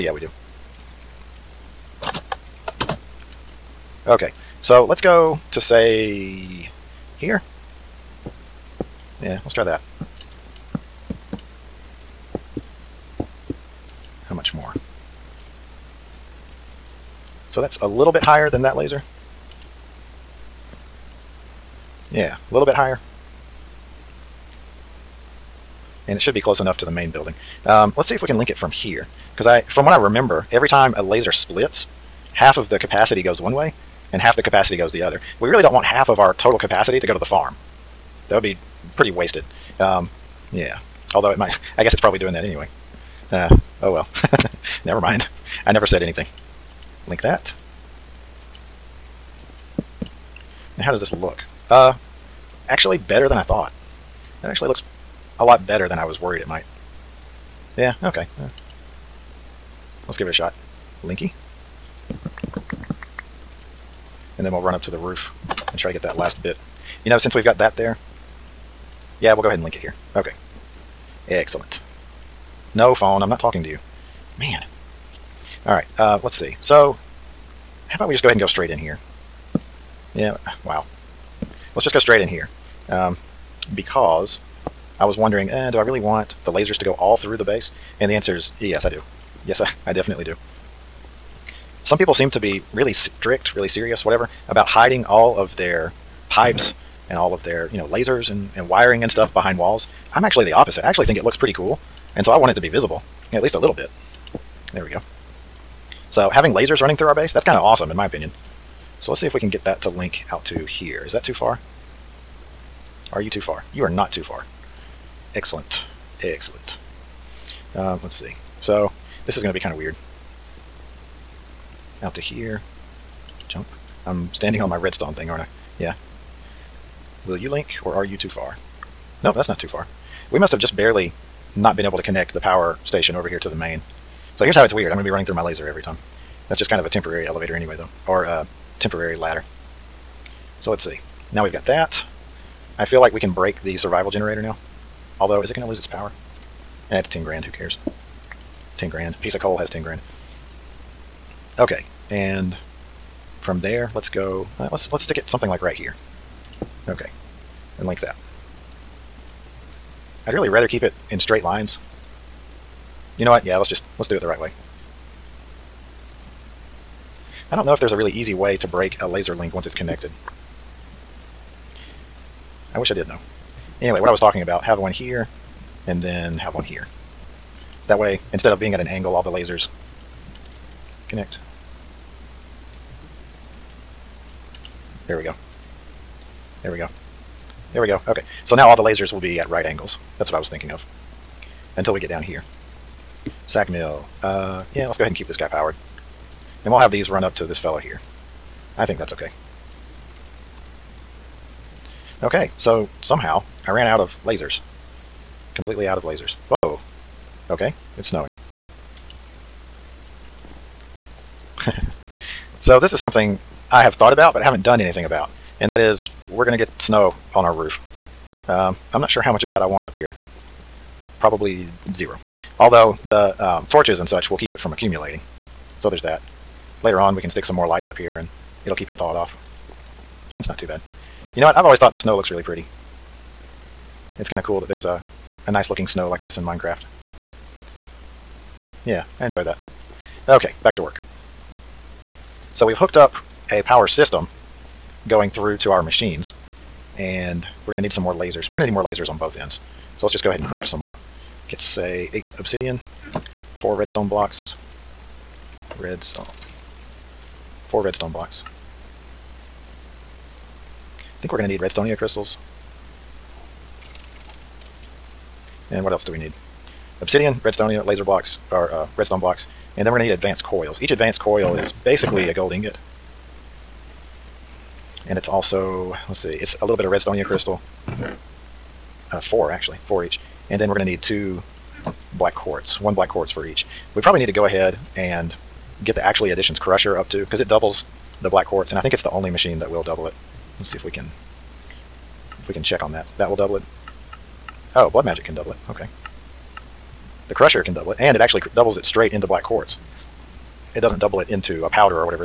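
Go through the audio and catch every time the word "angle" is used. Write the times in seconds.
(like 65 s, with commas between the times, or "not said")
178 s, 189 s.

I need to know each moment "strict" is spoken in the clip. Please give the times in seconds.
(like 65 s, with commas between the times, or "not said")
92 s.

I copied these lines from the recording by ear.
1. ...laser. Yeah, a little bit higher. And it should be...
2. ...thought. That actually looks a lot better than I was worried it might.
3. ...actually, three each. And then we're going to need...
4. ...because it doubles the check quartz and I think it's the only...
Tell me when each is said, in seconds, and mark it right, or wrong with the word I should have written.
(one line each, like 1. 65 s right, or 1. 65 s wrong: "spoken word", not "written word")
1. 18 s right
2. 53 s right
3. 279 s wrong: "four", not "three"
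4. 287 s wrong: "black", not "check".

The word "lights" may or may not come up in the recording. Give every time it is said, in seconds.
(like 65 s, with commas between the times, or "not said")
227 s.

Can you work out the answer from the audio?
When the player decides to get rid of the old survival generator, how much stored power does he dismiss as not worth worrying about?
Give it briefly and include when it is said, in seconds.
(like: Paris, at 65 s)
10 grand, at 146 s.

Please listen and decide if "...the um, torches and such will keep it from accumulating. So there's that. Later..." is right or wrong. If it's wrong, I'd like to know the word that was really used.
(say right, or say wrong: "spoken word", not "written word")
right.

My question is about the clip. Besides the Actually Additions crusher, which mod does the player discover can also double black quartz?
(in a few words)
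Blood Magic.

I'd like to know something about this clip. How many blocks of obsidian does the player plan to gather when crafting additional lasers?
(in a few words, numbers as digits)
8.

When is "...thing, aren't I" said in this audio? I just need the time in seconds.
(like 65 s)
125 s.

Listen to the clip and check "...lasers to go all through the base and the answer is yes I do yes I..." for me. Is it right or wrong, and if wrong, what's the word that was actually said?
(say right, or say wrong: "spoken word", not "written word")
right.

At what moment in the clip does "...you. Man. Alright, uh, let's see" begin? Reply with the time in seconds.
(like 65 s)
73 s.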